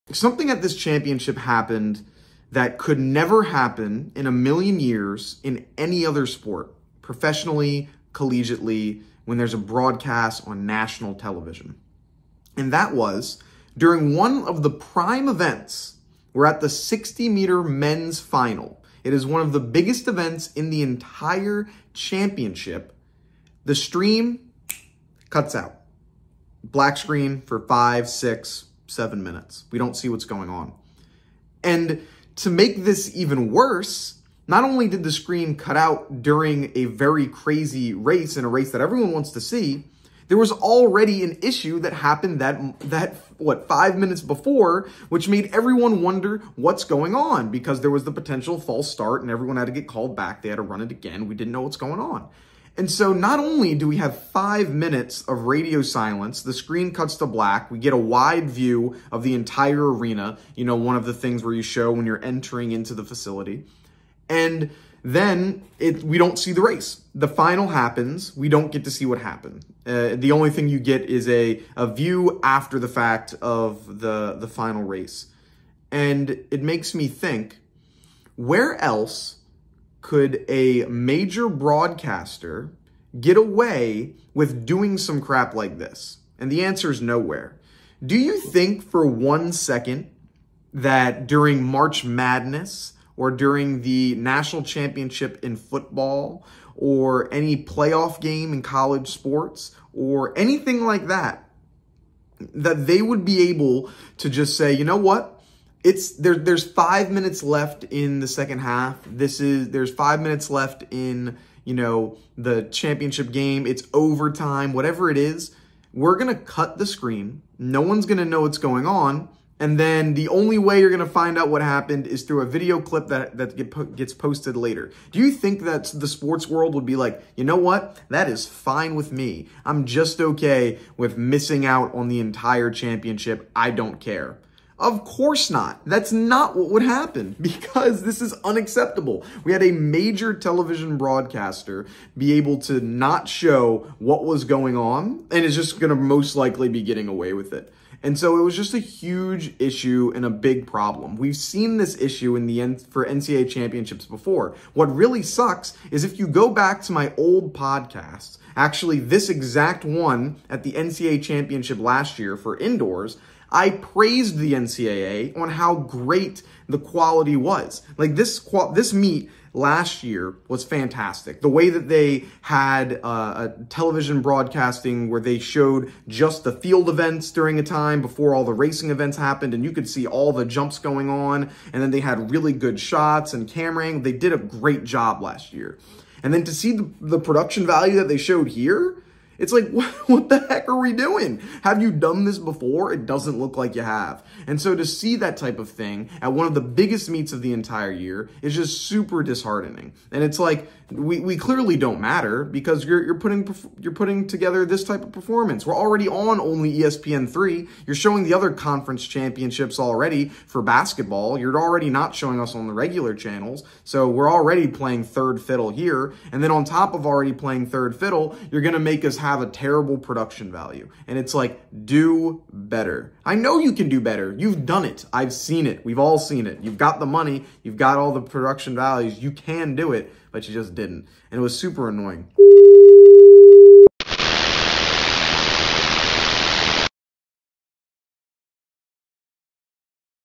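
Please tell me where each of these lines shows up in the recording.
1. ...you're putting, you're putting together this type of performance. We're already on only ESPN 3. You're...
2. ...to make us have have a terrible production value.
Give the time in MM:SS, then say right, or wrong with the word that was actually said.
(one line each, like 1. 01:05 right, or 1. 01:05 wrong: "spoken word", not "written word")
1. 03:23 right
2. 03:38 right.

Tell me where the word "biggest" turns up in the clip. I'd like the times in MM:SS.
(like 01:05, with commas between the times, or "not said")
00:19, 03:16.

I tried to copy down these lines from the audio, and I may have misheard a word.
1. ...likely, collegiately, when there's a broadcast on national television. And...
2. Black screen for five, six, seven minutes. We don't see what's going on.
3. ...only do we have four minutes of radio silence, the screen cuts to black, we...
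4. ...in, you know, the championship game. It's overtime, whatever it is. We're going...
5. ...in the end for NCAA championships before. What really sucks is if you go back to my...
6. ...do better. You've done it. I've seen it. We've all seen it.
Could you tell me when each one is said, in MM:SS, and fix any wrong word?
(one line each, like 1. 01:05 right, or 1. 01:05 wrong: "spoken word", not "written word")
1. 00:07 wrong: "professionally", not "likely"
2. 00:26 right
3. 00:53 wrong: "five", not "four"
4. 01:50 right
5. 02:32 right
6. 03:43 right.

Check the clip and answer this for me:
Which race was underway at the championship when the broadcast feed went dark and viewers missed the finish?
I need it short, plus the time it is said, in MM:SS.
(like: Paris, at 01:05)
60 meter men's final, at 00:16.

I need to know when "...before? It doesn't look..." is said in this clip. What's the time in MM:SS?
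03:12.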